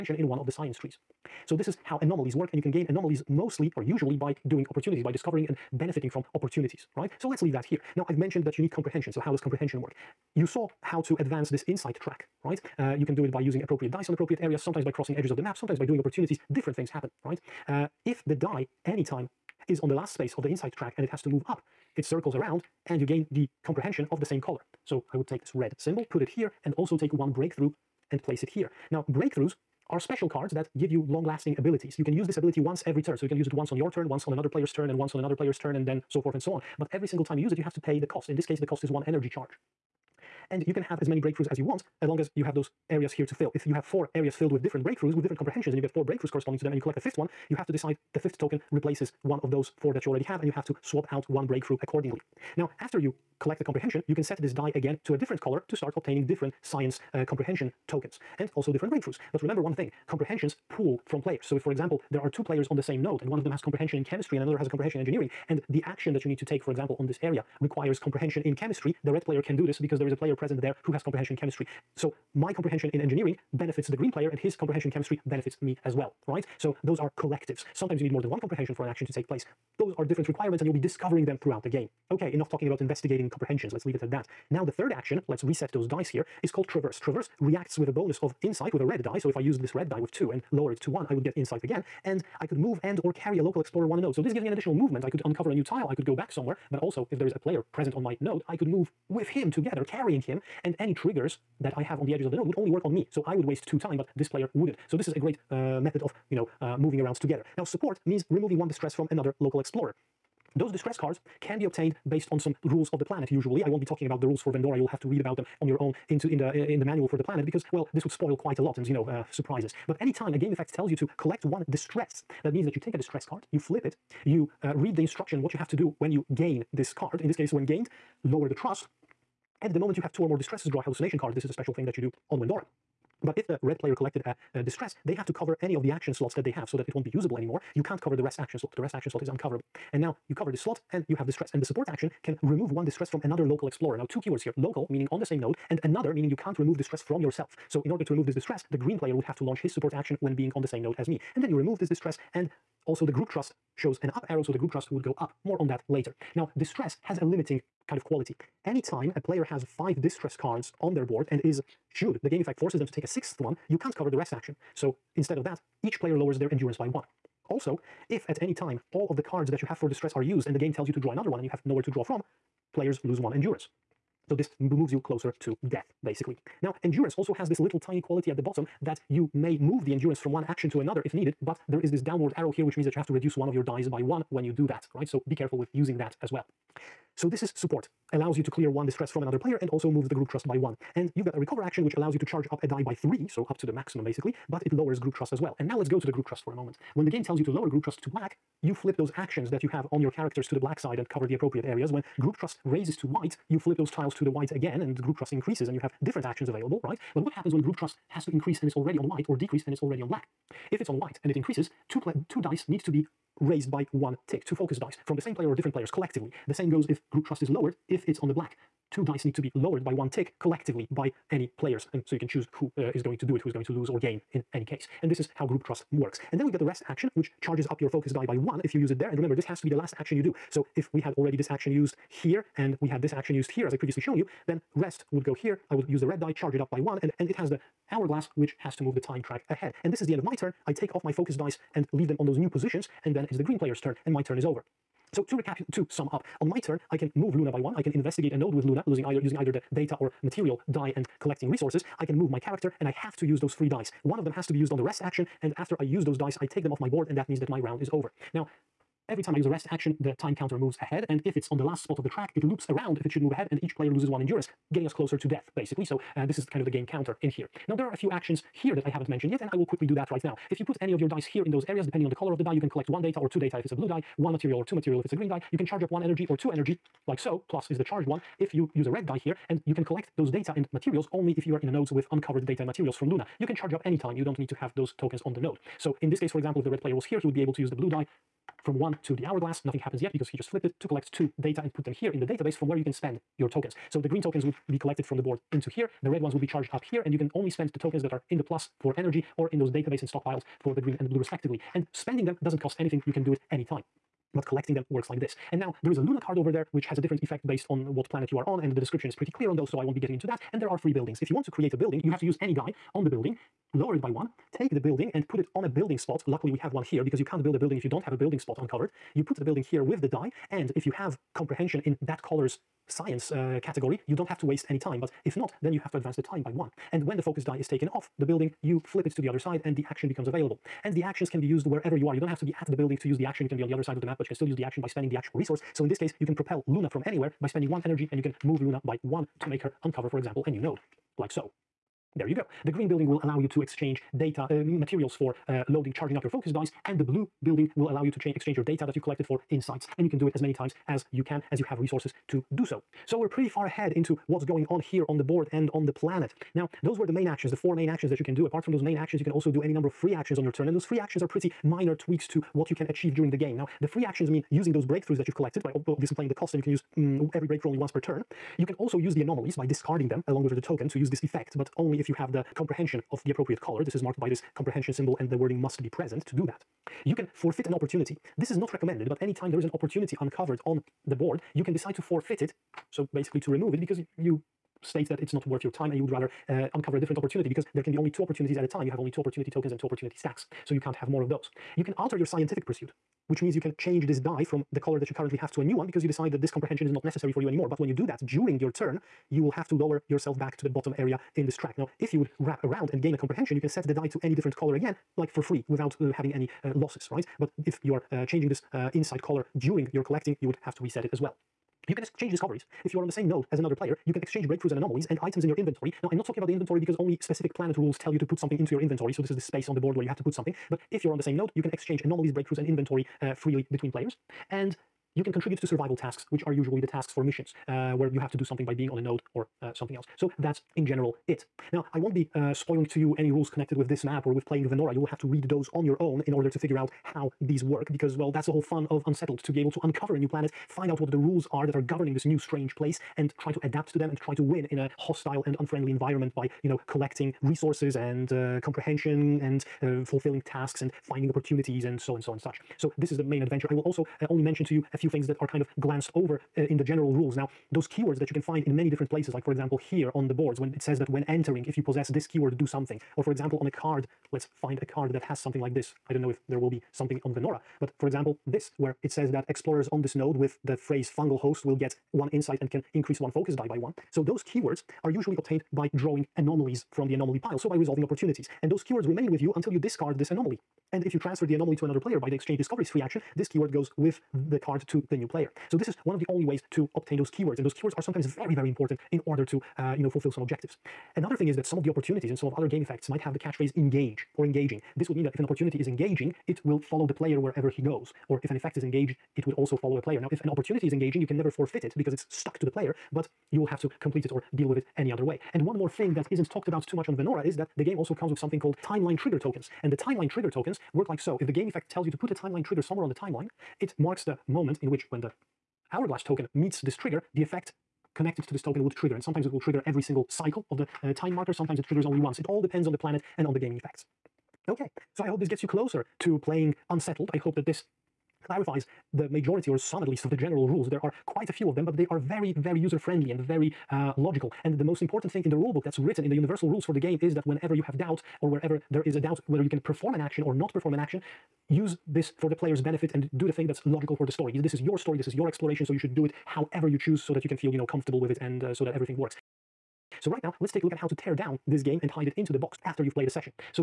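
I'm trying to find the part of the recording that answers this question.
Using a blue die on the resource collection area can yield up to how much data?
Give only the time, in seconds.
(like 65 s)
273 s.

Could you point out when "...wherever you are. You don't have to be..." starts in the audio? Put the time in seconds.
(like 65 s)
331 s.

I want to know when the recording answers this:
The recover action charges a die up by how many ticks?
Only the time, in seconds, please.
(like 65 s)
192 s.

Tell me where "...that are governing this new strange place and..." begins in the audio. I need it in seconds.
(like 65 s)
441 s.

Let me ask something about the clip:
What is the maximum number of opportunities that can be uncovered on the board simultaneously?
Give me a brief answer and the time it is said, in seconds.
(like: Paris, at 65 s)
2, at 387 s.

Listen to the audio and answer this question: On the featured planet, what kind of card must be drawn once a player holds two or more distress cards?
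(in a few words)
Hallucination card.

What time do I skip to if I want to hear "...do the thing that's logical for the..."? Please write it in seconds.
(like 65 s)
543 s.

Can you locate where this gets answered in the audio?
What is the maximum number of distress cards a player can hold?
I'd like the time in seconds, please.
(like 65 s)
159 s.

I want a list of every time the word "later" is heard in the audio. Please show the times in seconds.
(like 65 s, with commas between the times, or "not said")
155 s.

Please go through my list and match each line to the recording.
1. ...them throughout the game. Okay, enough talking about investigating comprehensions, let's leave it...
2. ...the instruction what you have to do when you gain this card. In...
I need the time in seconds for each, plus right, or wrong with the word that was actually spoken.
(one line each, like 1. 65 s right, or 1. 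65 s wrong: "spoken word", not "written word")
1. 81 s right
2. 124 s right.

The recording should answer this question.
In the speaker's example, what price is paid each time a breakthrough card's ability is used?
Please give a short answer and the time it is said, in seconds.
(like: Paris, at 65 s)
1 energy charge, at 38 s.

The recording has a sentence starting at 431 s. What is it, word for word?
Now, I won't be uh, spoiling to you any rules connected with this map or with playing Venora.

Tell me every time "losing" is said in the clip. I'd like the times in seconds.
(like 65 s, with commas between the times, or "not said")
248 s.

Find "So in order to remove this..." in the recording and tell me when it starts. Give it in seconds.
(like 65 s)
147 s.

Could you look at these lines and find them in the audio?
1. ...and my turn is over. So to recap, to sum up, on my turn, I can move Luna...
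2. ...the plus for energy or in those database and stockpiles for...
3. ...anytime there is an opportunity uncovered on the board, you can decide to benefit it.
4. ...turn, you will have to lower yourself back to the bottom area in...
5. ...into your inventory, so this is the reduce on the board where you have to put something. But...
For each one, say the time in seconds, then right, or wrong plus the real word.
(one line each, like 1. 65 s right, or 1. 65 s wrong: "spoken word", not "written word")
1. 244 s right
2. 298 s right
3. 379 s wrong: "forfeit", not "benefit"
4. 398 s right
5. 418 s wrong: "space", not "reduce".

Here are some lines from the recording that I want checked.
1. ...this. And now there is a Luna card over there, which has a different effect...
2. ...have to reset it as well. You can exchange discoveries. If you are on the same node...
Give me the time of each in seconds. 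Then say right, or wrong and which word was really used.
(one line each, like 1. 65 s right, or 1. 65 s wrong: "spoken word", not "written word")
1. 305 s right
2. 410 s right.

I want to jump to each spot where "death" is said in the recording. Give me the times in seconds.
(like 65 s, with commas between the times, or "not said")
175 s, 265 s.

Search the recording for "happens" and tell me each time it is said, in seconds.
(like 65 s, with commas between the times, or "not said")
16 s, 207 s, 289 s.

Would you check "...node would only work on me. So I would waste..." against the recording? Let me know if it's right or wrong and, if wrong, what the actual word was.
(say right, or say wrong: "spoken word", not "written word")
right.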